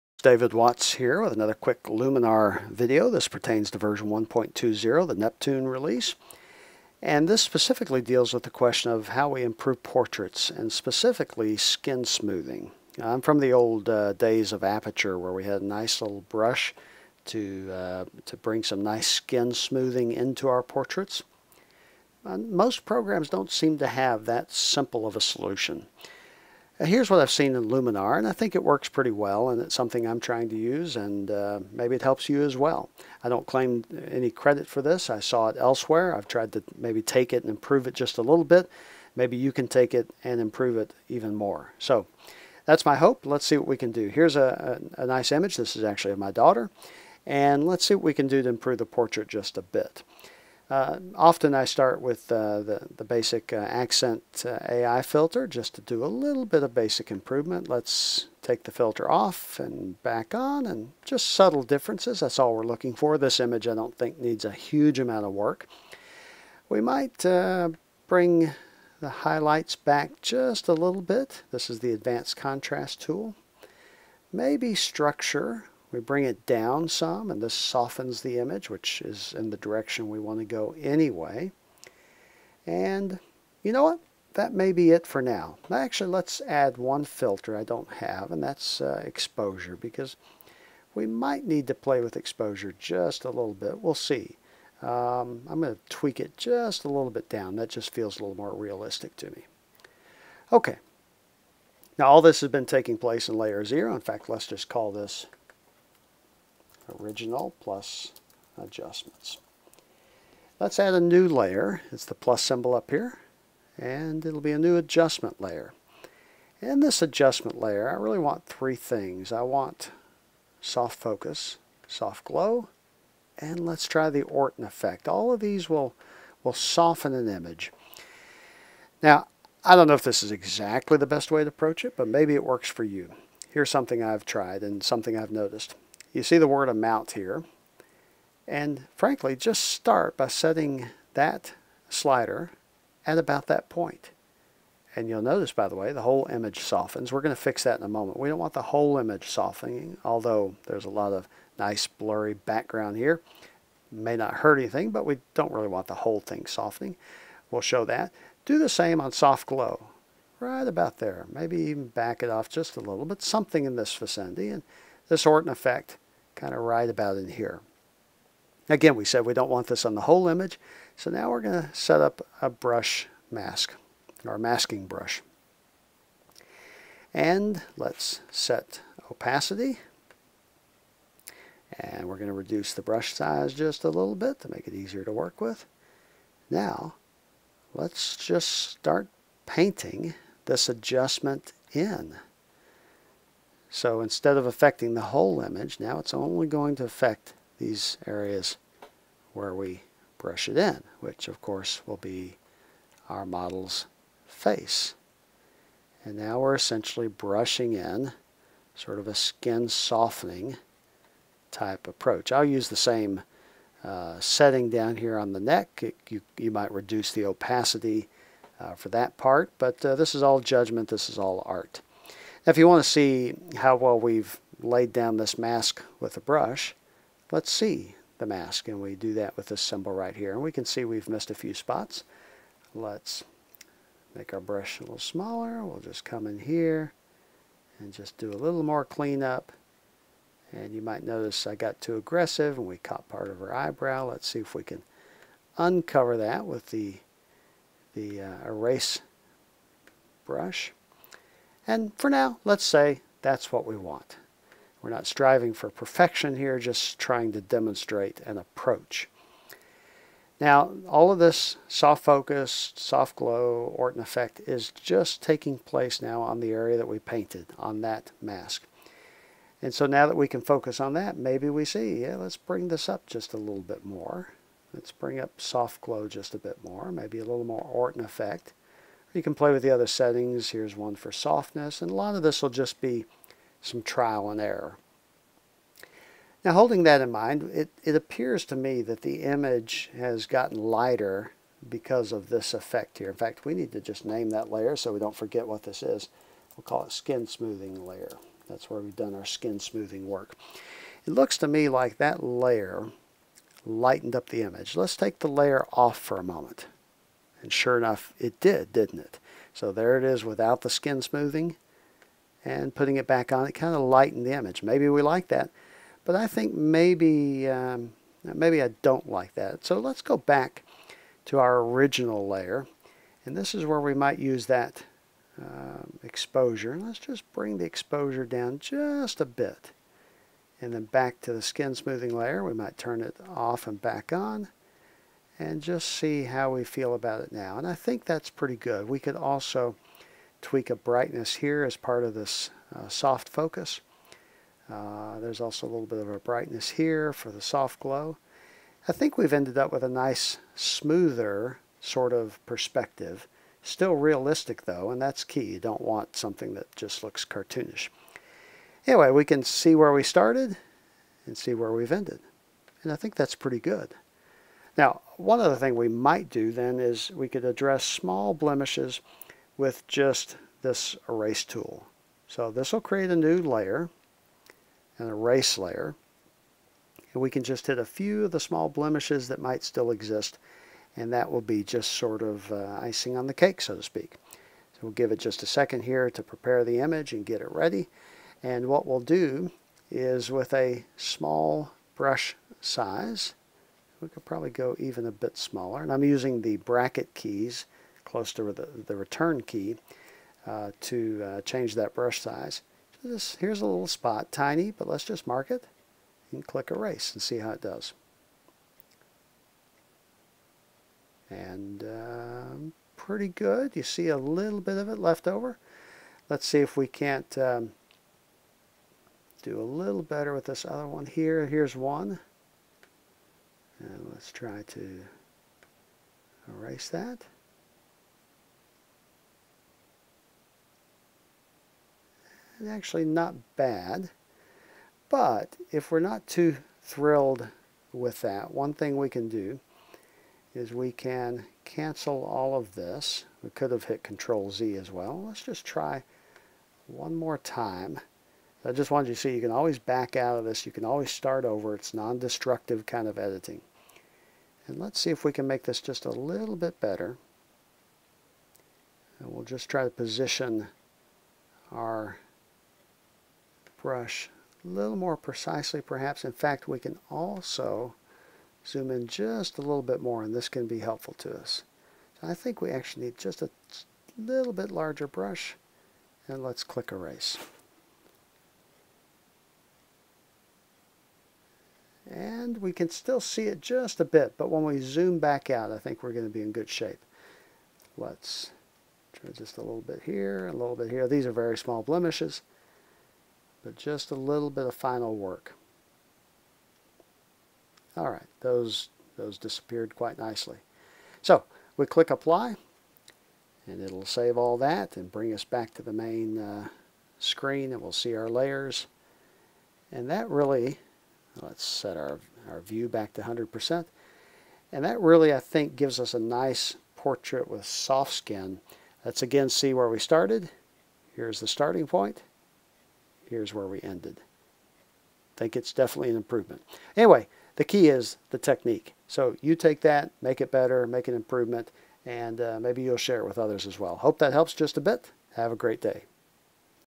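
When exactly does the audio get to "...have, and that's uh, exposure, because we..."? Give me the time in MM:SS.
01:27.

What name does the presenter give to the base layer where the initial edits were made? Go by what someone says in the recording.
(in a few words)
original plus adjustments.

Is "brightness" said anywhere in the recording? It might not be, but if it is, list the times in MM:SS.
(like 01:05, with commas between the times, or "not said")
05:40, 05:46.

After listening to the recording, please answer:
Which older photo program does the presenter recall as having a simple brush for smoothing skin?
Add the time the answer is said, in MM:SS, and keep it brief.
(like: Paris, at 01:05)
Aperture, at 00:14.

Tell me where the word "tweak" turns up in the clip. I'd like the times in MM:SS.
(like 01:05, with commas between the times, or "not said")
01:35, 05:40.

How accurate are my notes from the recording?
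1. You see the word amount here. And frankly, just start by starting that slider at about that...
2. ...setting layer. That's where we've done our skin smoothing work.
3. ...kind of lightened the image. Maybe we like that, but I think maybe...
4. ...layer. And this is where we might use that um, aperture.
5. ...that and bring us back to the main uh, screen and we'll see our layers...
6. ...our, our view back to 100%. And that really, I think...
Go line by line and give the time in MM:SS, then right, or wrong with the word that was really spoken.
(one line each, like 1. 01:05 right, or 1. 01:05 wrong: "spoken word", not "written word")
1. 02:16 wrong: "setting", not "starting"
2. 04:57 wrong: "smoothing", not "setting"
3. 05:13 right
4. 05:22 wrong: "exposure", not "aperture"
5. 08:24 right
6. 08:31 right.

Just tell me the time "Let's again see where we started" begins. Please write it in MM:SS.
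08:39.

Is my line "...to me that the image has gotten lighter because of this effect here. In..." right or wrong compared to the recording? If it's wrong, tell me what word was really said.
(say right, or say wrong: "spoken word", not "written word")
right.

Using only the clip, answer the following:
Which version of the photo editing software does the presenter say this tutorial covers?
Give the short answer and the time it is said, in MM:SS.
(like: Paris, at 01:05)
1.20, at 00:03.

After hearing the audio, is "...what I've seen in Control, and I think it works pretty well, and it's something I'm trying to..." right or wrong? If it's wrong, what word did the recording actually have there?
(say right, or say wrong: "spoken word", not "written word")
wrong: "Luminar", not "Control".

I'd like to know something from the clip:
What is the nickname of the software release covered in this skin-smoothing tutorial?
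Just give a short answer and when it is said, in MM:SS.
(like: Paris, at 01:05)
Neptune, at 00:05.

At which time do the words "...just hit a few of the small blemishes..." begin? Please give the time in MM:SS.
06:17.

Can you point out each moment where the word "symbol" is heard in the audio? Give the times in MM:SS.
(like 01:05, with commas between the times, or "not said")
01:52, 03:49.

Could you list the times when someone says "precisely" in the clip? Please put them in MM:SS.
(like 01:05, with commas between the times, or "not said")
07:45.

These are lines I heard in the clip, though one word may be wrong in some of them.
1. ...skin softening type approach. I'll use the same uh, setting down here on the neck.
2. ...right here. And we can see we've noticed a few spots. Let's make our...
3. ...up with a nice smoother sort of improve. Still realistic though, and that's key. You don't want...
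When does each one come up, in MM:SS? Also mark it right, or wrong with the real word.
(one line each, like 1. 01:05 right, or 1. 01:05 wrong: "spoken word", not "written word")
1. 03:29 right
2. 03:49 wrong: "missed", not "noticed"
3. 05:49 wrong: "perspective", not "improve".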